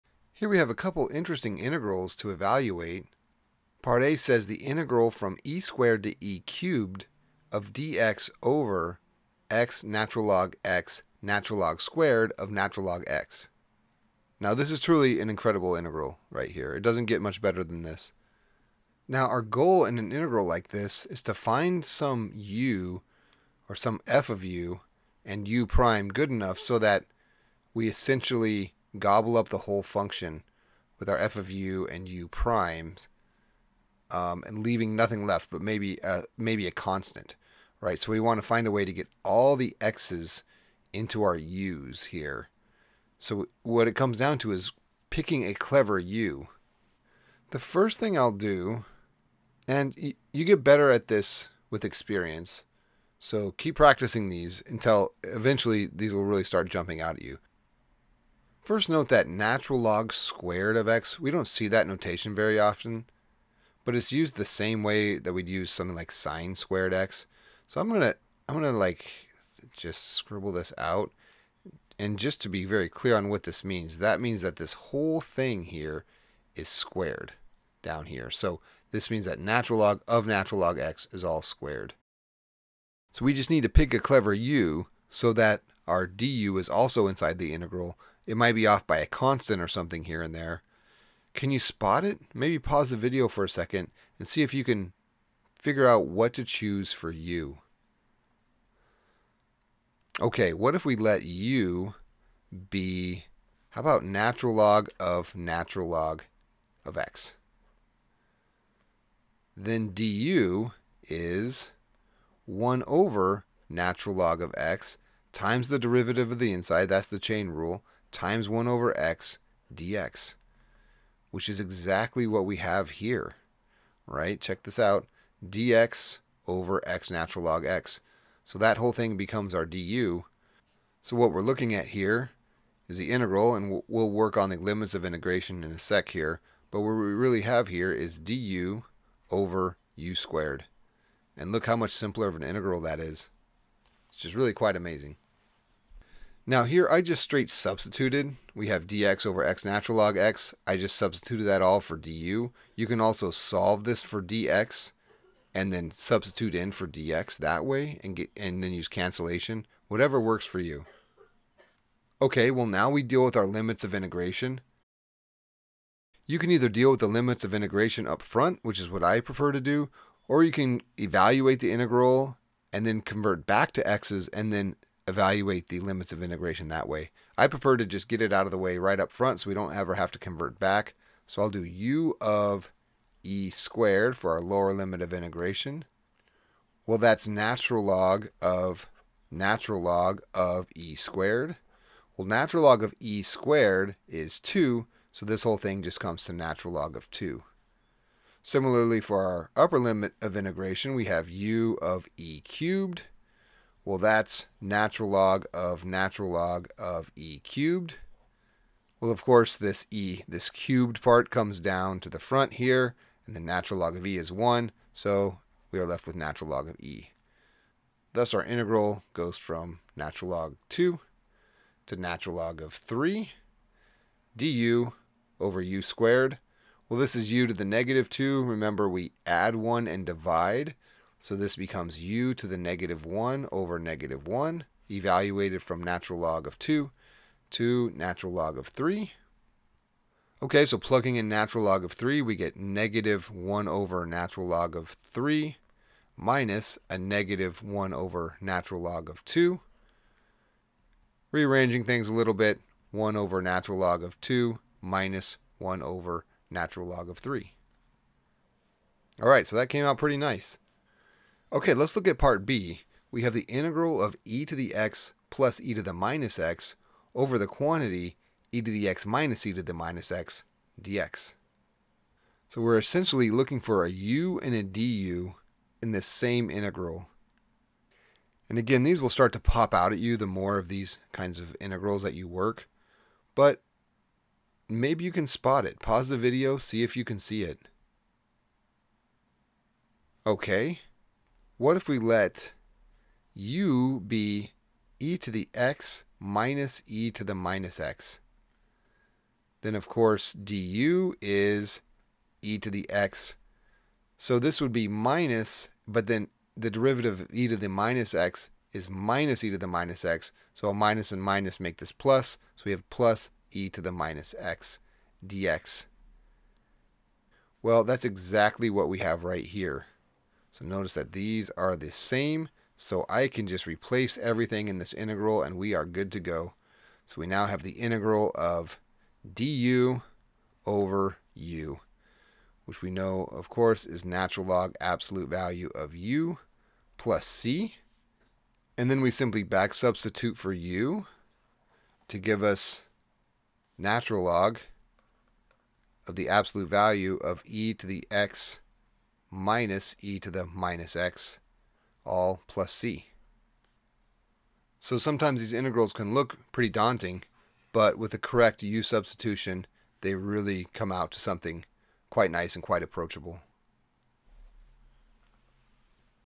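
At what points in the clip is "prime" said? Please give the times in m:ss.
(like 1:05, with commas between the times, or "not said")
0:25, 0:32.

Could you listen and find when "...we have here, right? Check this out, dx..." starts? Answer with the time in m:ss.
2:02.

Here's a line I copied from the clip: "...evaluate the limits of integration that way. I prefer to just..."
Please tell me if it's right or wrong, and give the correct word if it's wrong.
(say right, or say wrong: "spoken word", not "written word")
right.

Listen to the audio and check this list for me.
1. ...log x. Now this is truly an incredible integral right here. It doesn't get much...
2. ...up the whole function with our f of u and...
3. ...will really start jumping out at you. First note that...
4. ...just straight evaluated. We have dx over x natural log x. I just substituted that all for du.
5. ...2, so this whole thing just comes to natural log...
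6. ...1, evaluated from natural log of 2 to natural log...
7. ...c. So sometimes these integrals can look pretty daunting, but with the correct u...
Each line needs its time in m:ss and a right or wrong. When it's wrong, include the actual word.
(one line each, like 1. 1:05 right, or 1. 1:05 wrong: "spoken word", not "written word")
1. 0:12 right
2. 0:29 right
3. 0:56 right
4. 2:27 wrong: "substituted", not "evaluated"
5. 3:14 right
6. 3:54 right
7. 5:52 right.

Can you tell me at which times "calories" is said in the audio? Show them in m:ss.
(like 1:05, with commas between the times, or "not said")
not said.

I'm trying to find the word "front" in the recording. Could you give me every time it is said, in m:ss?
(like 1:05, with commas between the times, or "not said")
2:48, 2:59, 3:32.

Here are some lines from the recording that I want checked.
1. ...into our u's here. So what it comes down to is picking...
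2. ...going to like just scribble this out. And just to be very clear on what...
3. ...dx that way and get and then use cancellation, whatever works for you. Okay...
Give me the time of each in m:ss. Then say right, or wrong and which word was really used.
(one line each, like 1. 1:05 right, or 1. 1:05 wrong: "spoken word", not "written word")
1. 0:40 right
2. 1:08 right
3. 2:36 right.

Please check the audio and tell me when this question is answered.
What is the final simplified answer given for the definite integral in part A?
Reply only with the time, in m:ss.
4:12.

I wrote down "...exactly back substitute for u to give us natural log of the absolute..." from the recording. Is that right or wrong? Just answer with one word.
wrong.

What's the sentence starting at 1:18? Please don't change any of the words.
So this means that natural log of natural log x is all squared.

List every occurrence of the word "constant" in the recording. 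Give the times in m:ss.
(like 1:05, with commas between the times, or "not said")
0:36, 1:29.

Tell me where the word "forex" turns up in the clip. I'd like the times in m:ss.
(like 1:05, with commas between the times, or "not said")
not said.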